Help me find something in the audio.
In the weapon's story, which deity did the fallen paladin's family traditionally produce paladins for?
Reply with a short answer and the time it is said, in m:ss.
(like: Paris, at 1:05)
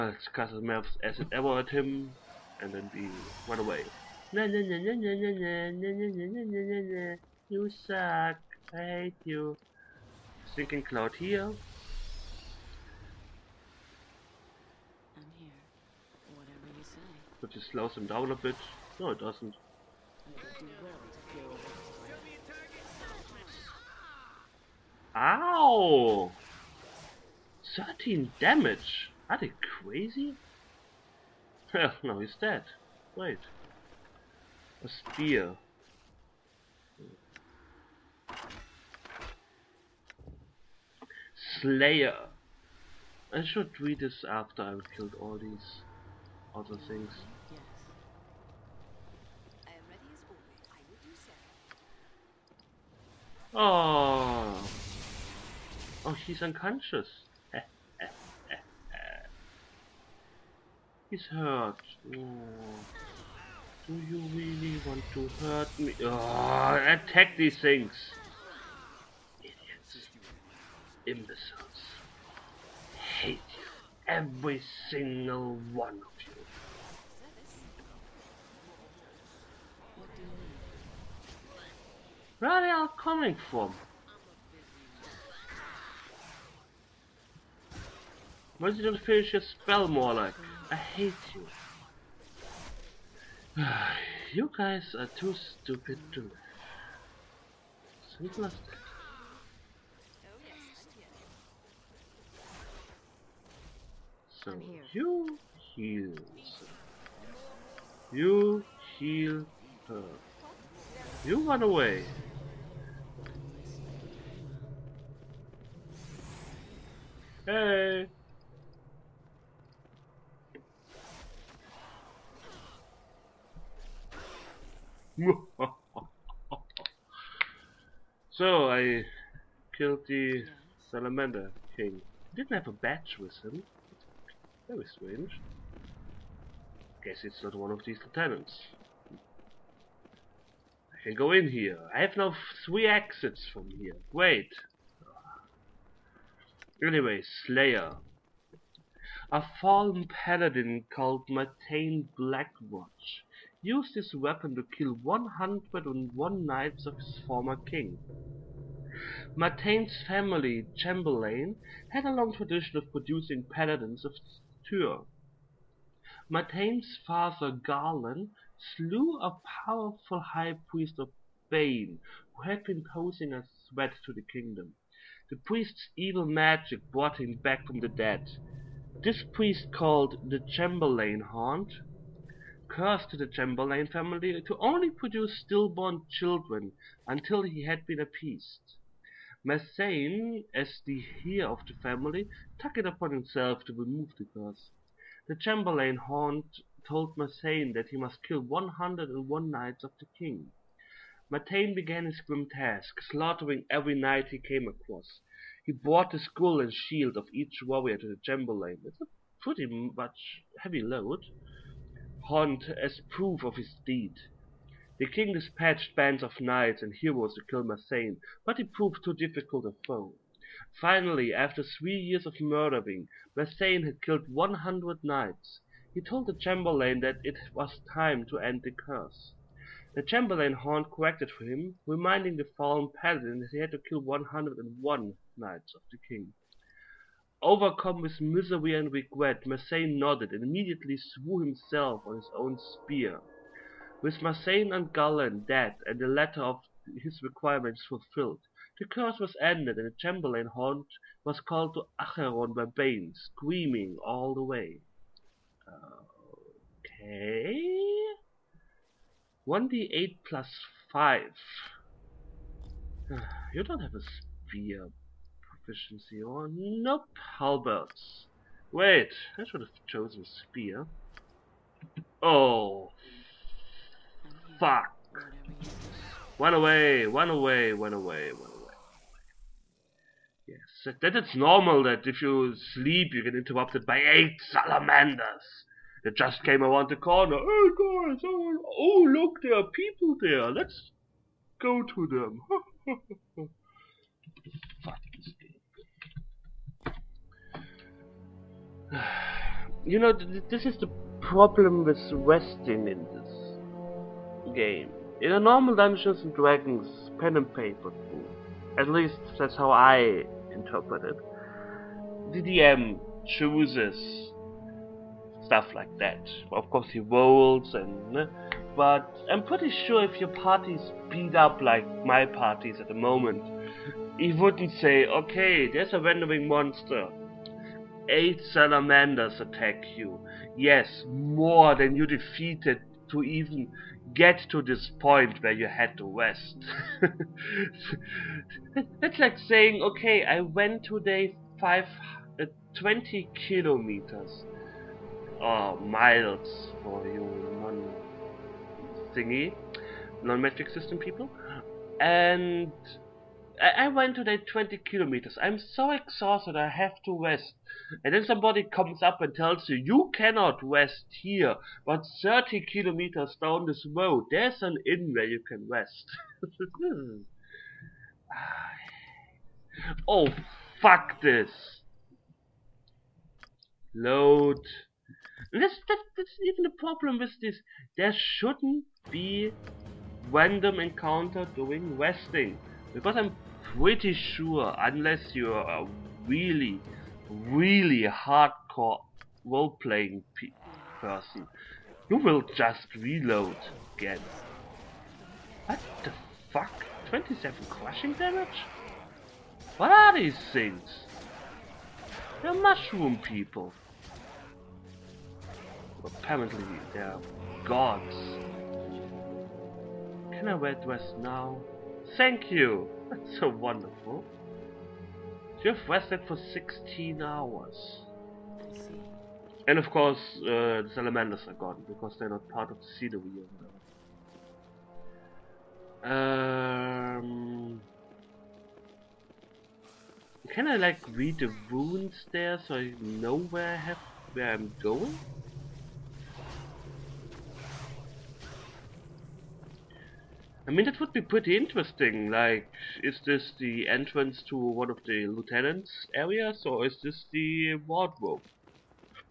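Tyr, at 2:44.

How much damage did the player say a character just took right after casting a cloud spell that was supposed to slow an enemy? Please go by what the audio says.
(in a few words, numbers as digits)
13.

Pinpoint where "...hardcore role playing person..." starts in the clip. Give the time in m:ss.
6:28.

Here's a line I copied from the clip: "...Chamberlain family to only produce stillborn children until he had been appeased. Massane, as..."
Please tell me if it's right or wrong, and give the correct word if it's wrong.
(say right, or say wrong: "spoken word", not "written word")
right.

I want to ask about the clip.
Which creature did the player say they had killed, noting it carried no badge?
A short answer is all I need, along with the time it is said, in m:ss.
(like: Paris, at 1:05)
salamander king, at 2:10.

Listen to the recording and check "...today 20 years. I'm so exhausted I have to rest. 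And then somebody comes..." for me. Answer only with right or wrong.
wrong.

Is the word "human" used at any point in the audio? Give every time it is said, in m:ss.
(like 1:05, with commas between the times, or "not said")
not said.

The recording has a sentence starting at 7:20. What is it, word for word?
I mean, that would be pretty interesting.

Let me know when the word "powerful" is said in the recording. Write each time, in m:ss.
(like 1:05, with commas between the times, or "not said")
2:49.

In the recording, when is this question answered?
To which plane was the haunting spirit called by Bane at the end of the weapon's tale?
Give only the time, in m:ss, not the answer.
4:12.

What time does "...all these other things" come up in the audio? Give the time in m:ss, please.
0:45.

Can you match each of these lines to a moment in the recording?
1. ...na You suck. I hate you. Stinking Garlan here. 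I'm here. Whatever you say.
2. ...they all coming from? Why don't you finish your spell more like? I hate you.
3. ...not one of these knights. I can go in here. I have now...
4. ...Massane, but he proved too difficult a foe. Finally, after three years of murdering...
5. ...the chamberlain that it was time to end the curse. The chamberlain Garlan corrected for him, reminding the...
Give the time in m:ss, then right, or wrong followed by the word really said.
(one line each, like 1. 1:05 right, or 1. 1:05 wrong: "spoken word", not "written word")
1. 0:06 wrong: "Cloud", not "Garlan"
2. 1:22 right
3. 2:17 wrong: "lieutenants", not "knights"
4. 3:37 right
5. 3:46 wrong: "Horn", not "Garlan".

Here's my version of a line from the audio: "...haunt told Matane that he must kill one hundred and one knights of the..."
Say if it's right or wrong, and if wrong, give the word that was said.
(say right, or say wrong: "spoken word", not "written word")
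wrong: "Massane", not "Matane".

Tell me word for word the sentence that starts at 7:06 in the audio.
Um, can I like read the runes there so I know where I have where I'm going?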